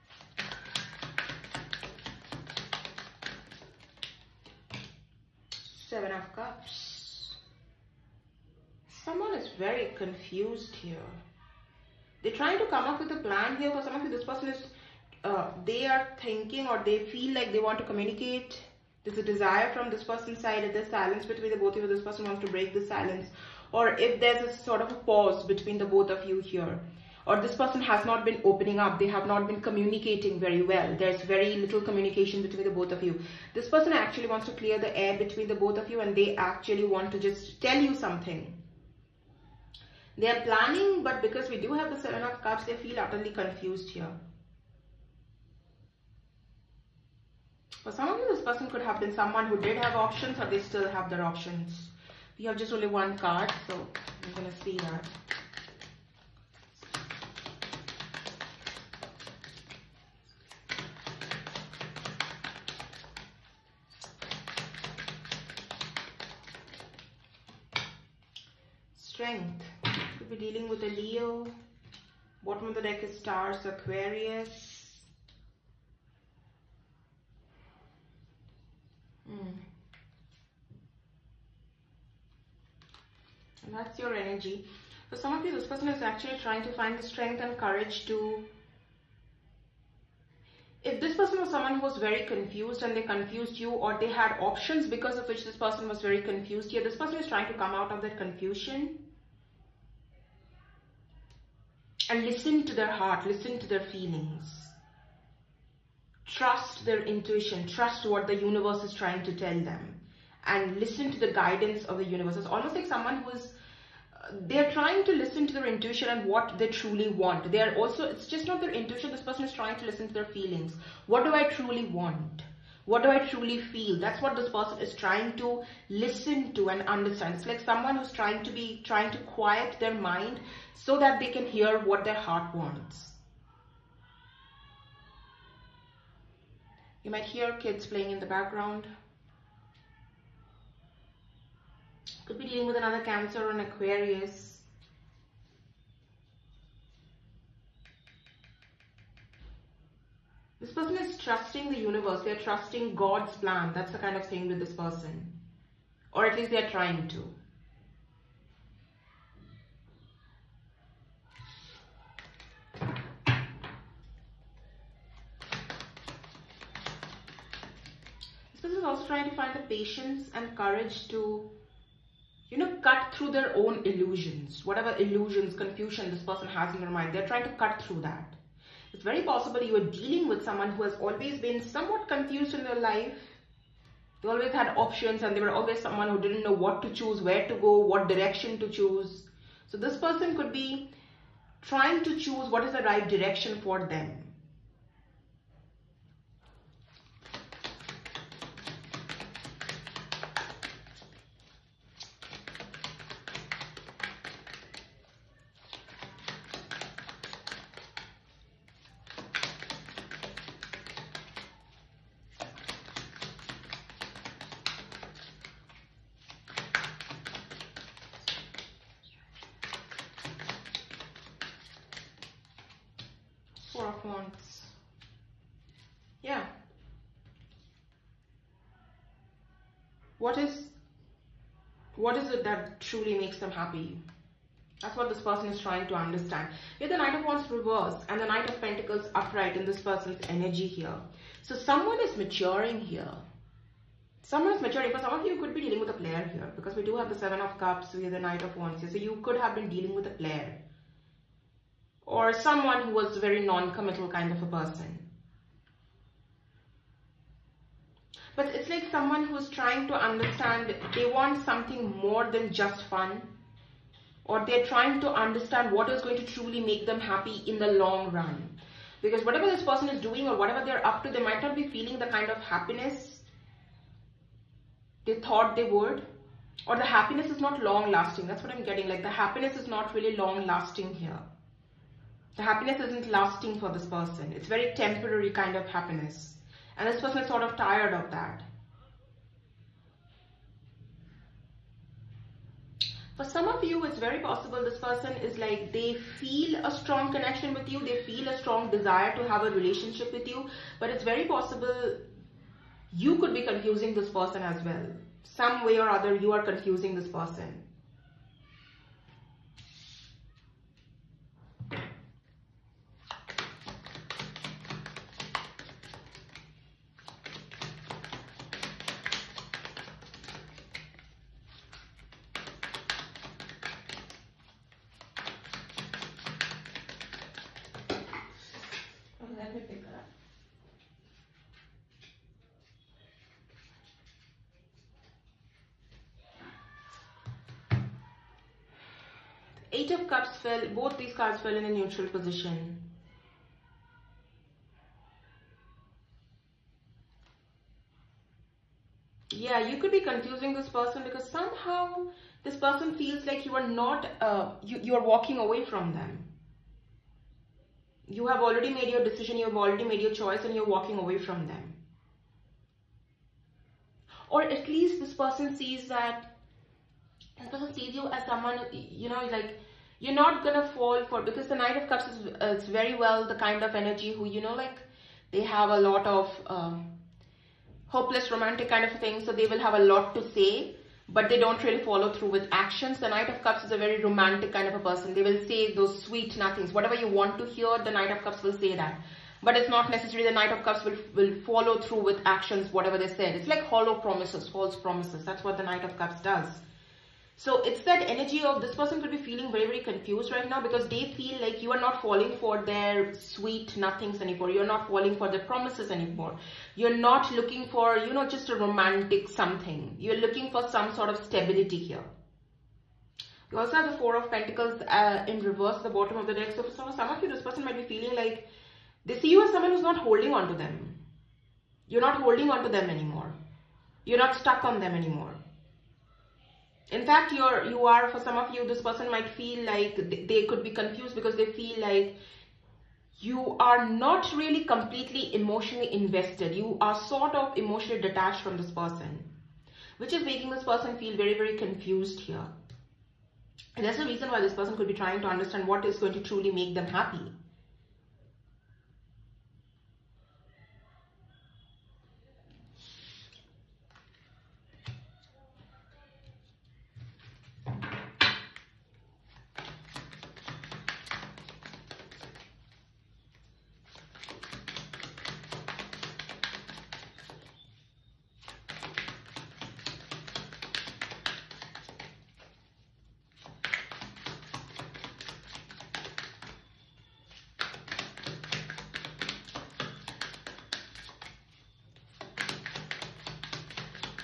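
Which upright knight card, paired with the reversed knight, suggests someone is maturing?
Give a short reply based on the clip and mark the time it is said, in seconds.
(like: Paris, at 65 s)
Knight of Pentacles, at 238 s.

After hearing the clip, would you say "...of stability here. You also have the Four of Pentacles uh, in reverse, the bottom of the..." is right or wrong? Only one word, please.
right.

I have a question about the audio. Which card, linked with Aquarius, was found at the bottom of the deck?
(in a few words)
Stars.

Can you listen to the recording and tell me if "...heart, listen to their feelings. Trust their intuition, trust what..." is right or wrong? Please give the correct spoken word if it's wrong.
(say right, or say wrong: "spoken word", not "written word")
right.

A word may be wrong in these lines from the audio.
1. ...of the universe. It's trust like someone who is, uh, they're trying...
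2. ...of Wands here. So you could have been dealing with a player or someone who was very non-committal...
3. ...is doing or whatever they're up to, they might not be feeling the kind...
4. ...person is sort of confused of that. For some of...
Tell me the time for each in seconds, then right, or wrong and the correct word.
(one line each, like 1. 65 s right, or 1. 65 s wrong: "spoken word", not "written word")
1. 111 s wrong: "almost", not "trust"
2. 248 s right
3. 269 s right
4. 287 s wrong: "tired", not "confused".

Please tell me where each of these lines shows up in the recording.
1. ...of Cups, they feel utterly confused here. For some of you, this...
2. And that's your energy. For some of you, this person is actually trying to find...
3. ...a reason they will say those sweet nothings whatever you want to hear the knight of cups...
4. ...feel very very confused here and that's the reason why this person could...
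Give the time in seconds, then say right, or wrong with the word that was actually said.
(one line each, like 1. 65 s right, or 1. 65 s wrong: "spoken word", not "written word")
1. 42 s right
2. 83 s right
3. 384 s wrong: "person", not "reason"
4. 440 s right.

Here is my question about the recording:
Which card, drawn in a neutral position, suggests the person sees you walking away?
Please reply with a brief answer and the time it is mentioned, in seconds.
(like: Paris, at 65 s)
Eight of Cups, at 339 s.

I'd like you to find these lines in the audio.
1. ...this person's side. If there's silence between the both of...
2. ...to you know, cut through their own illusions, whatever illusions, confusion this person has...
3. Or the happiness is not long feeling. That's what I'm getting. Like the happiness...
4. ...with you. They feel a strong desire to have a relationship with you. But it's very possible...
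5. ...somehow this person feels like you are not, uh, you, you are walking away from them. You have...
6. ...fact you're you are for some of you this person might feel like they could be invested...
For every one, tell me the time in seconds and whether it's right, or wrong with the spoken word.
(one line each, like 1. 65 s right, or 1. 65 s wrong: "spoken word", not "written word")
1. 19 s right
2. 171 s right
3. 276 s wrong: "lasting", not "feeling"
4. 297 s right
5. 351 s right
6. 427 s wrong: "confused", not "invested".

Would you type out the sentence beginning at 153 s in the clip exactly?
That's the kind of thing with this person.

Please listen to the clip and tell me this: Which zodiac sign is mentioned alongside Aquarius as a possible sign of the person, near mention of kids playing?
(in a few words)
Cancer.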